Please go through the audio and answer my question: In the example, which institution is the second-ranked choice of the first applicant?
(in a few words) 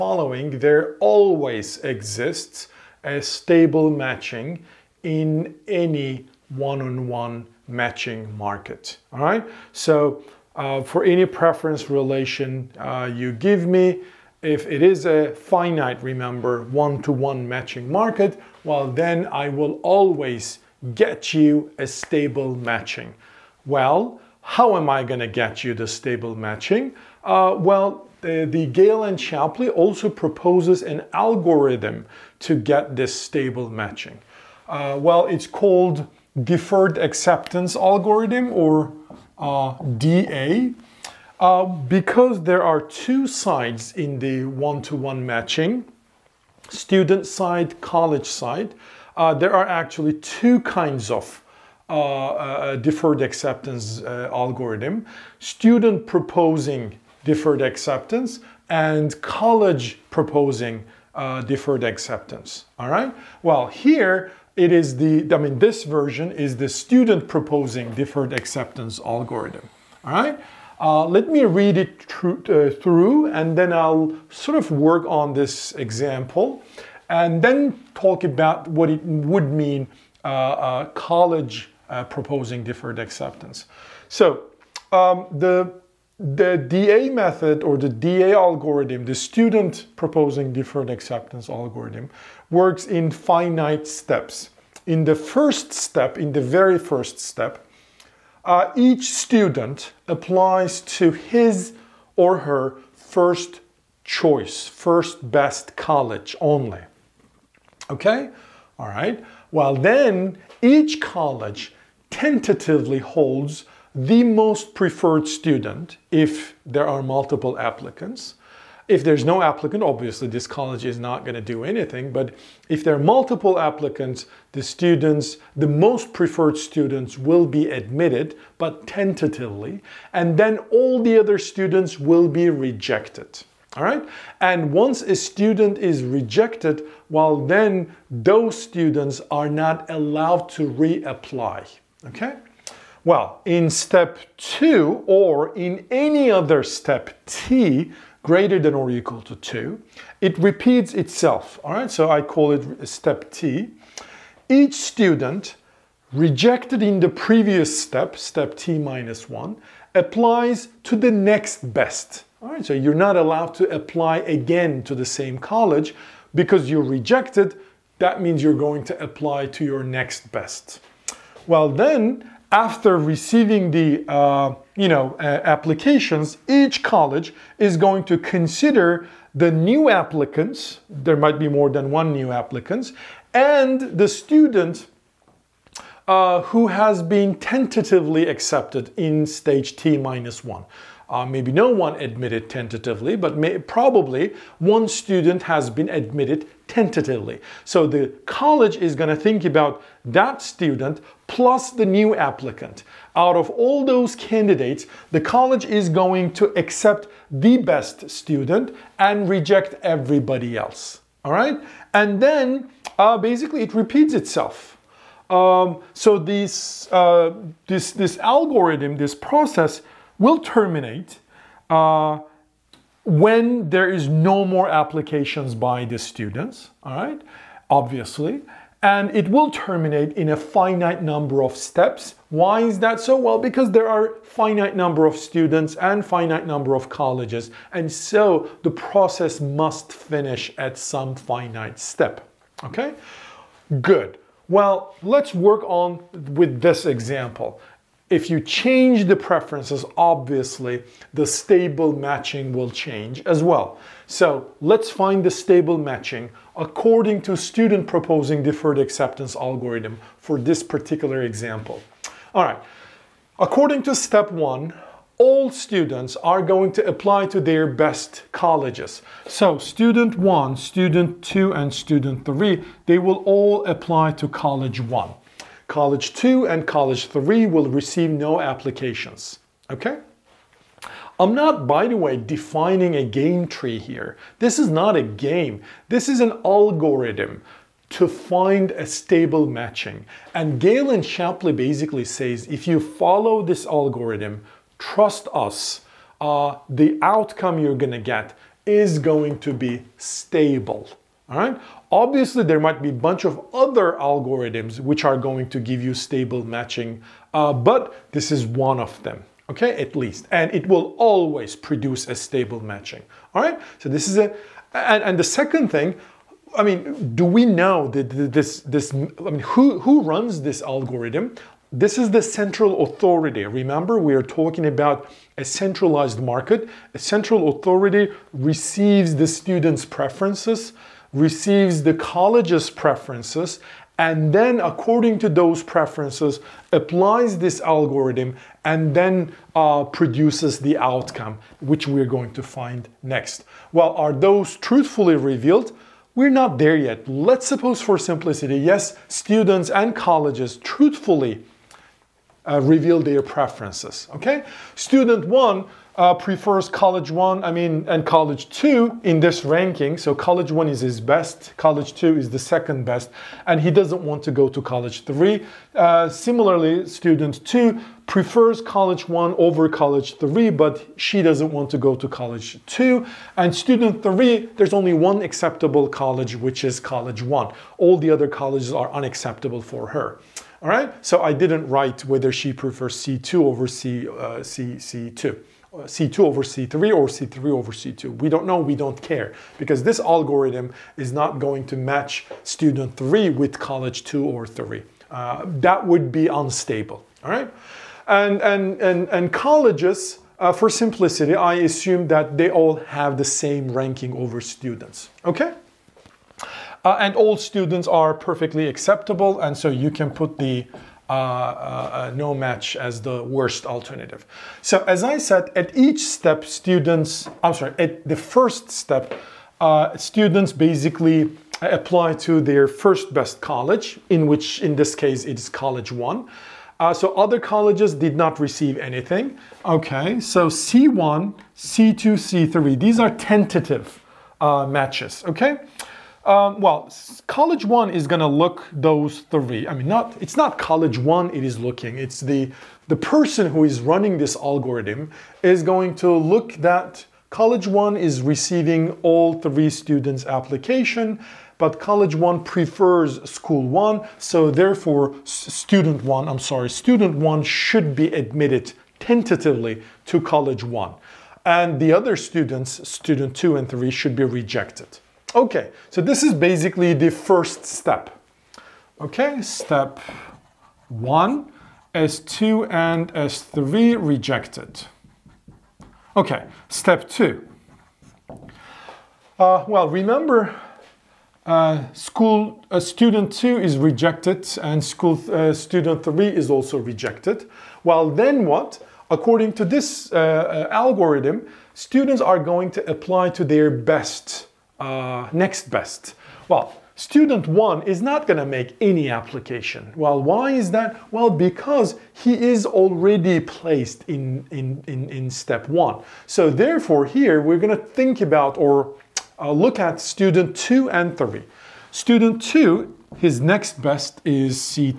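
College 2.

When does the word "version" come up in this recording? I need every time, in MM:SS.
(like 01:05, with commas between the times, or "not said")
01:05.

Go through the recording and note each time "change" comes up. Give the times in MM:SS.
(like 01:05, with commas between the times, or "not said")
04:08, 04:12.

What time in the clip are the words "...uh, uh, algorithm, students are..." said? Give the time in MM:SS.
08:10.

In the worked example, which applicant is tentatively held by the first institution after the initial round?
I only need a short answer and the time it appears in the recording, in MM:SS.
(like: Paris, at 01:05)
Student 1, at 07:36.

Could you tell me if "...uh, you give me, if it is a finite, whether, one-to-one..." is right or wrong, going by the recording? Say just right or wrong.
wrong.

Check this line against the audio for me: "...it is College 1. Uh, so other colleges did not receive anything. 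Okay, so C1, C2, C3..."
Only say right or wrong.
right.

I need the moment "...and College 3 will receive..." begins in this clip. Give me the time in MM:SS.
04:36.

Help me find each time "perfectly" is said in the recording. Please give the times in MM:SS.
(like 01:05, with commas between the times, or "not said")
06:48.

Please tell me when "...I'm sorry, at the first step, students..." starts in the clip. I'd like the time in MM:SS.
06:57.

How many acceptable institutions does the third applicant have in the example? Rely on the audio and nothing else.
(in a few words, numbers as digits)
1.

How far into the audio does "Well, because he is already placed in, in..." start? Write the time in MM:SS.
08:21.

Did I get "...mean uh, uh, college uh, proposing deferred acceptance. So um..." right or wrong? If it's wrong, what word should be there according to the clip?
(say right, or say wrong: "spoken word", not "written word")
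right.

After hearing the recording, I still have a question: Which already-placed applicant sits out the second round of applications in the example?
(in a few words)
Student 1.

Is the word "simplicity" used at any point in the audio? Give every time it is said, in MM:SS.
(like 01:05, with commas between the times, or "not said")
05:47, 06:40.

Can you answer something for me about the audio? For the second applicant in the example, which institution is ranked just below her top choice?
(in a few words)
College 3.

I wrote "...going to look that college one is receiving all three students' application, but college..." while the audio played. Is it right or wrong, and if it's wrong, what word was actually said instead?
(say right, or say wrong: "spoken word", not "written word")
right.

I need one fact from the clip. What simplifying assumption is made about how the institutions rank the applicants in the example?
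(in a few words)
Same ranking.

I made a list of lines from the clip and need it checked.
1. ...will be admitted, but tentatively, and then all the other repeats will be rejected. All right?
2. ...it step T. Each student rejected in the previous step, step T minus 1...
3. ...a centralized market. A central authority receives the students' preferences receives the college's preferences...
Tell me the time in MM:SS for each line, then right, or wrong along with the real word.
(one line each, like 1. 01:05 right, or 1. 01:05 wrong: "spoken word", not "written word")
1. 02:07 wrong: "students", not "repeats"
2. 02:32 right
3. 05:25 right.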